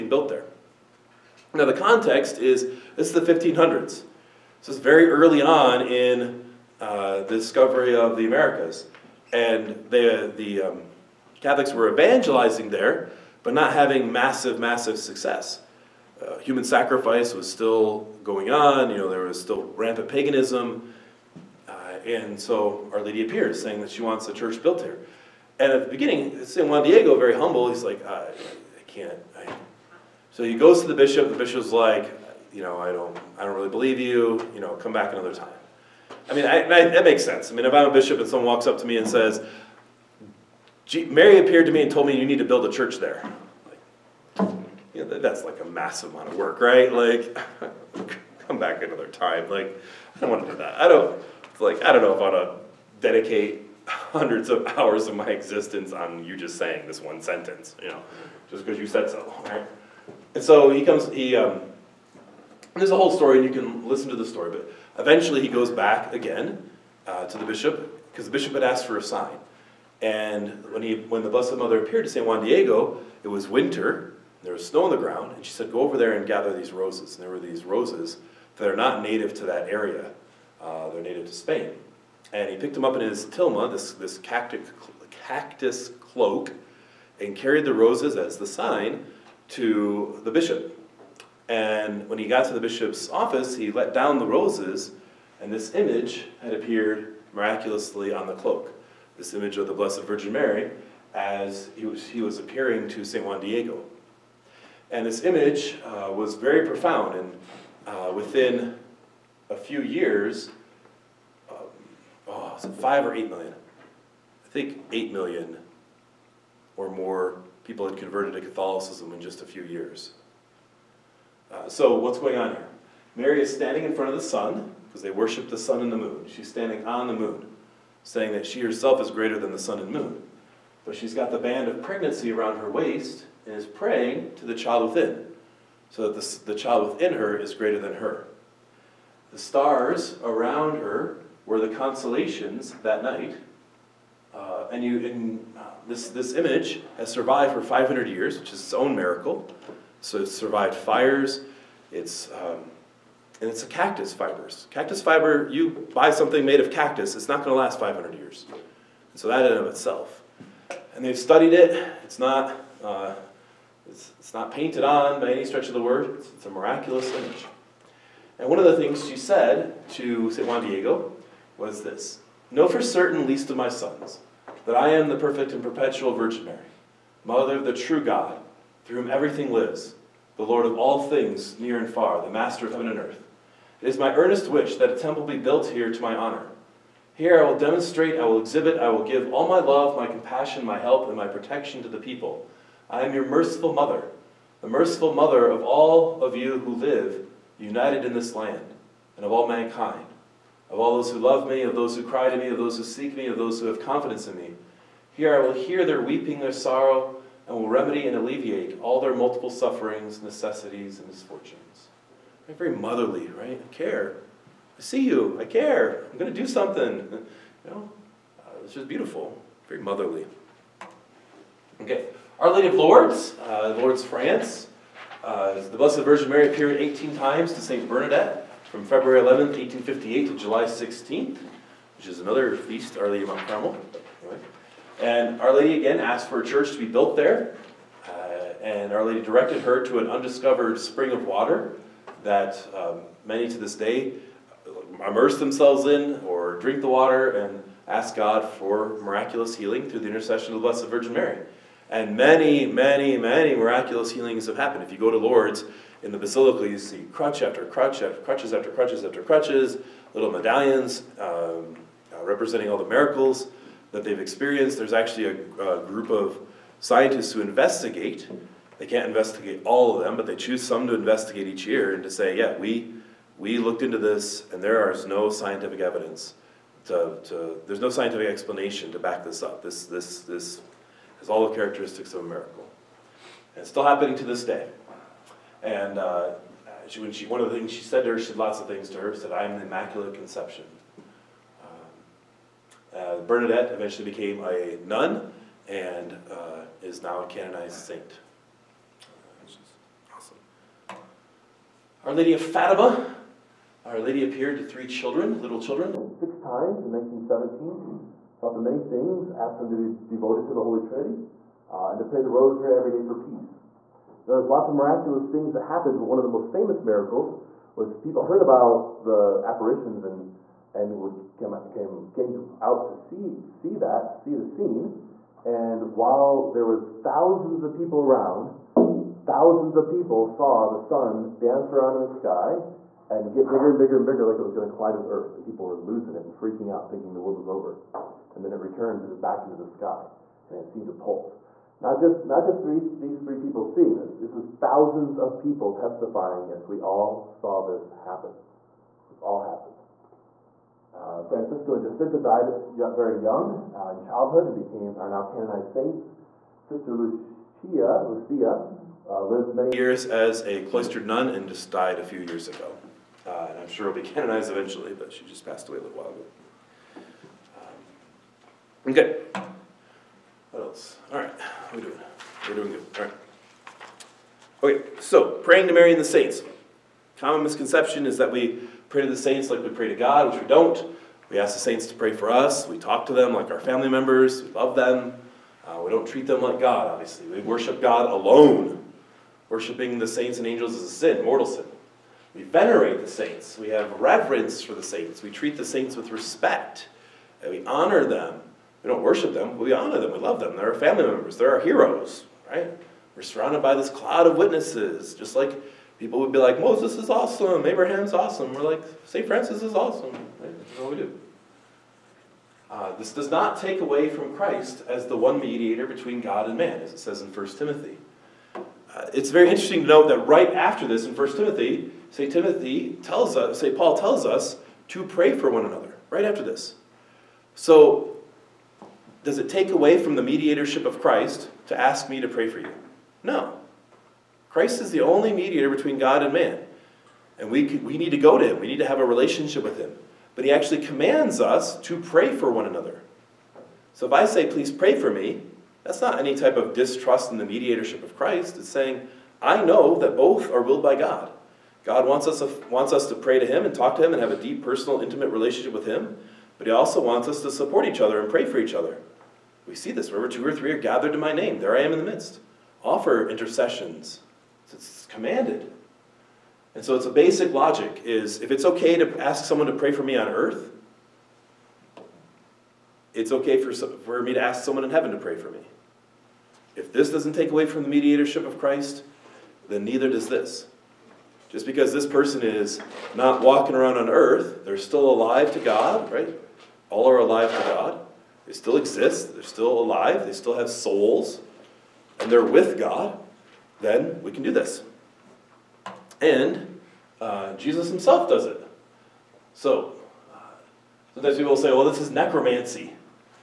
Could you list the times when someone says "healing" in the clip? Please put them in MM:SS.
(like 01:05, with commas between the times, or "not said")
04:09, 04:14.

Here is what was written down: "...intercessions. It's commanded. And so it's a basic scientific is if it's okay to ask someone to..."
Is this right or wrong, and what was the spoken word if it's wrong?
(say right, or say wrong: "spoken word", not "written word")
wrong: "logic", not "scientific".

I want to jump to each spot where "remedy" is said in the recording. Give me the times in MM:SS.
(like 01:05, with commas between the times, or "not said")
03:27.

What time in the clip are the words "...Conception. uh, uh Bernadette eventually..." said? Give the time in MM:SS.
04:50.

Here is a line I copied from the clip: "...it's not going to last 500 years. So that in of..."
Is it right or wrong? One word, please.
right.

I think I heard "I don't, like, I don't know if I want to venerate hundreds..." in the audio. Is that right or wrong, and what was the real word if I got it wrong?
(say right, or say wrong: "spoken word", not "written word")
wrong: "dedicate", not "venerate".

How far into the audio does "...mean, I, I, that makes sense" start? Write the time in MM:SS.
00:36.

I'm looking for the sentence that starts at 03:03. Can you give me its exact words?
It is my earnest wish that a temple be built here to my honor.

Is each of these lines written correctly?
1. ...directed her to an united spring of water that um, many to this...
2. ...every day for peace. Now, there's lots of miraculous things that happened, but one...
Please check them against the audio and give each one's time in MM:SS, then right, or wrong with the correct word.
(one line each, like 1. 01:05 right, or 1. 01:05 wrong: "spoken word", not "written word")
1. 03:59 wrong: "undiscovered", not "united"
2. 05:12 right.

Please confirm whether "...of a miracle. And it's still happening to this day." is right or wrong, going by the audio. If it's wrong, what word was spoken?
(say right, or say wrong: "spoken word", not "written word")
right.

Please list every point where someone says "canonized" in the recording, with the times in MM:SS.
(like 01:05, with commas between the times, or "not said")
04:57, 05:55, 06:04.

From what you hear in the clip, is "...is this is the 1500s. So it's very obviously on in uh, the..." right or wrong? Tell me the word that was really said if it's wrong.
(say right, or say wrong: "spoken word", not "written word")
wrong: "early", not "obviously".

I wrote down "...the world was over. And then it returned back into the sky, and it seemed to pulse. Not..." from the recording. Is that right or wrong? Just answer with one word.
right.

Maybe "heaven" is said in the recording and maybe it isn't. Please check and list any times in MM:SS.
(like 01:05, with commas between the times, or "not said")
03:02, 07:54.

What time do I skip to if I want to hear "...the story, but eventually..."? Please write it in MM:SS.
01:04.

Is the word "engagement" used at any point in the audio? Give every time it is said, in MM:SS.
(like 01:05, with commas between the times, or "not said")
not said.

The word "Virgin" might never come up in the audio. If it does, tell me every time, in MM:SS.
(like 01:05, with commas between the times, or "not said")
01:40, 02:56, 03:46, 04:10.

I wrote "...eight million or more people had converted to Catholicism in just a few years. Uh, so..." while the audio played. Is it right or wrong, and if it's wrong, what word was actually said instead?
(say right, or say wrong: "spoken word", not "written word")
right.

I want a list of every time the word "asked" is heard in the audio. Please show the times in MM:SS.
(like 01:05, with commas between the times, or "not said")
01:08, 03:55, 05:09.